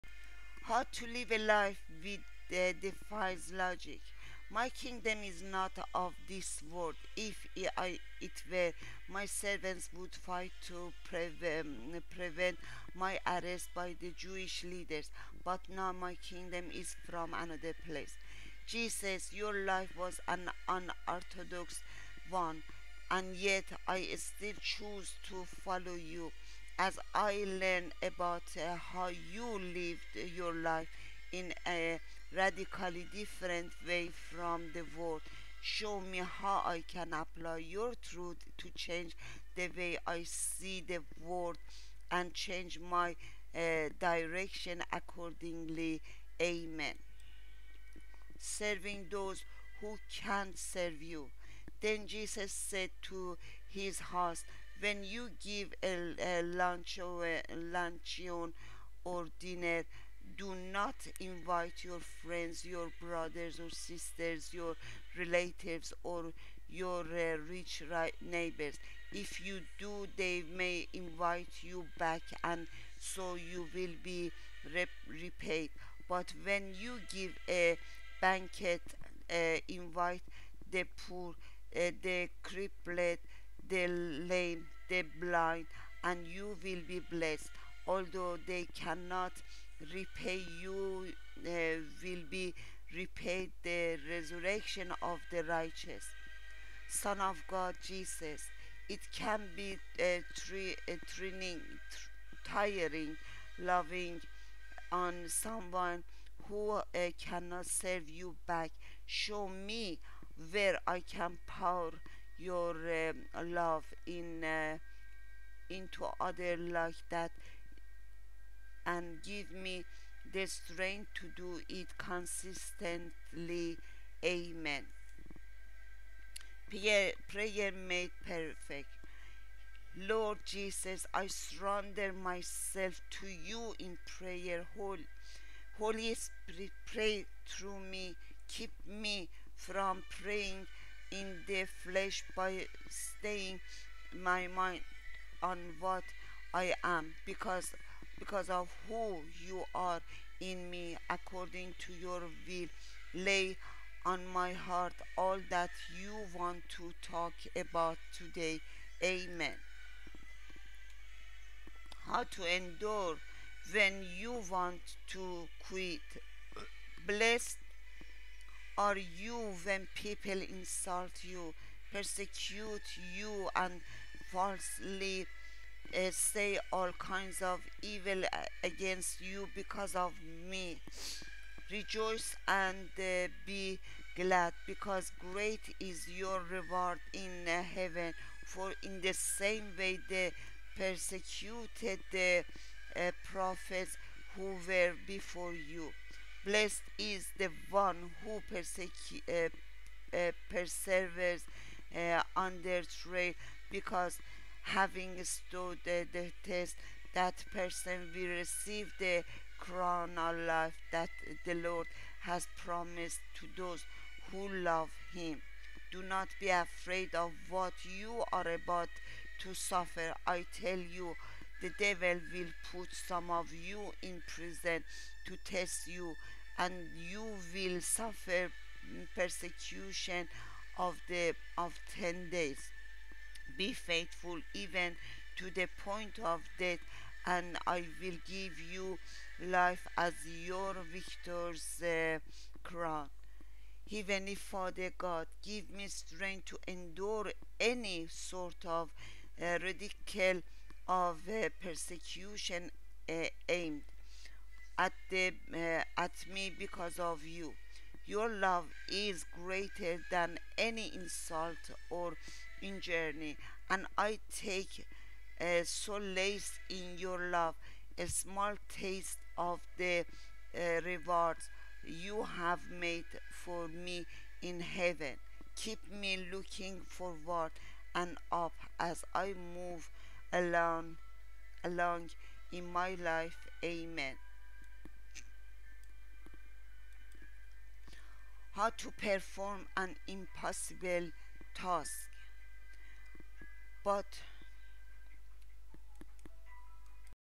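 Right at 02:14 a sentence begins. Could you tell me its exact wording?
Holy, Holy Spirit, pray through me.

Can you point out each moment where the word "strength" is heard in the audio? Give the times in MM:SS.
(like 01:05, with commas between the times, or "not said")
02:00, 04:05.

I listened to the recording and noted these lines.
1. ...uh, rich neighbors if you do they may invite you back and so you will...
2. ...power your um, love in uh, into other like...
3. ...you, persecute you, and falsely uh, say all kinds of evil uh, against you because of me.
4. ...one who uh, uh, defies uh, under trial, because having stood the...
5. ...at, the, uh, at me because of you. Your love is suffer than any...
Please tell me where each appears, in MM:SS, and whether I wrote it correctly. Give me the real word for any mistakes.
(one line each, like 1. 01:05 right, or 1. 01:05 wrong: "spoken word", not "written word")
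1. 01:07 right
2. 01:51 right
3. 02:51 right
4. 03:17 wrong: "perseveres", not "defies"
5. 04:14 wrong: "greater", not "suffer".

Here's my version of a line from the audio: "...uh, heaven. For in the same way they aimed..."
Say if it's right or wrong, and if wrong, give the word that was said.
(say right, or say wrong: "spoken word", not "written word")
wrong: "persecuted", not "aimed".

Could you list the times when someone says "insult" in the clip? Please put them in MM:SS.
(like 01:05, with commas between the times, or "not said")
02:50, 04:20.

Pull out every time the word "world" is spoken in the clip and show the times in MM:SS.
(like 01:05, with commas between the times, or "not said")
00:06, 00:34, 00:41.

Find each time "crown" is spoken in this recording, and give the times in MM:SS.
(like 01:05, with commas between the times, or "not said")
03:29, 04:02.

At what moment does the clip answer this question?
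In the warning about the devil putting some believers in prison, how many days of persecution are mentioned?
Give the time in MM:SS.
03:51.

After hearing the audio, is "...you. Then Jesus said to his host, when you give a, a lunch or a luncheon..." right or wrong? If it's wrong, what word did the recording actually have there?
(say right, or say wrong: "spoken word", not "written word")
right.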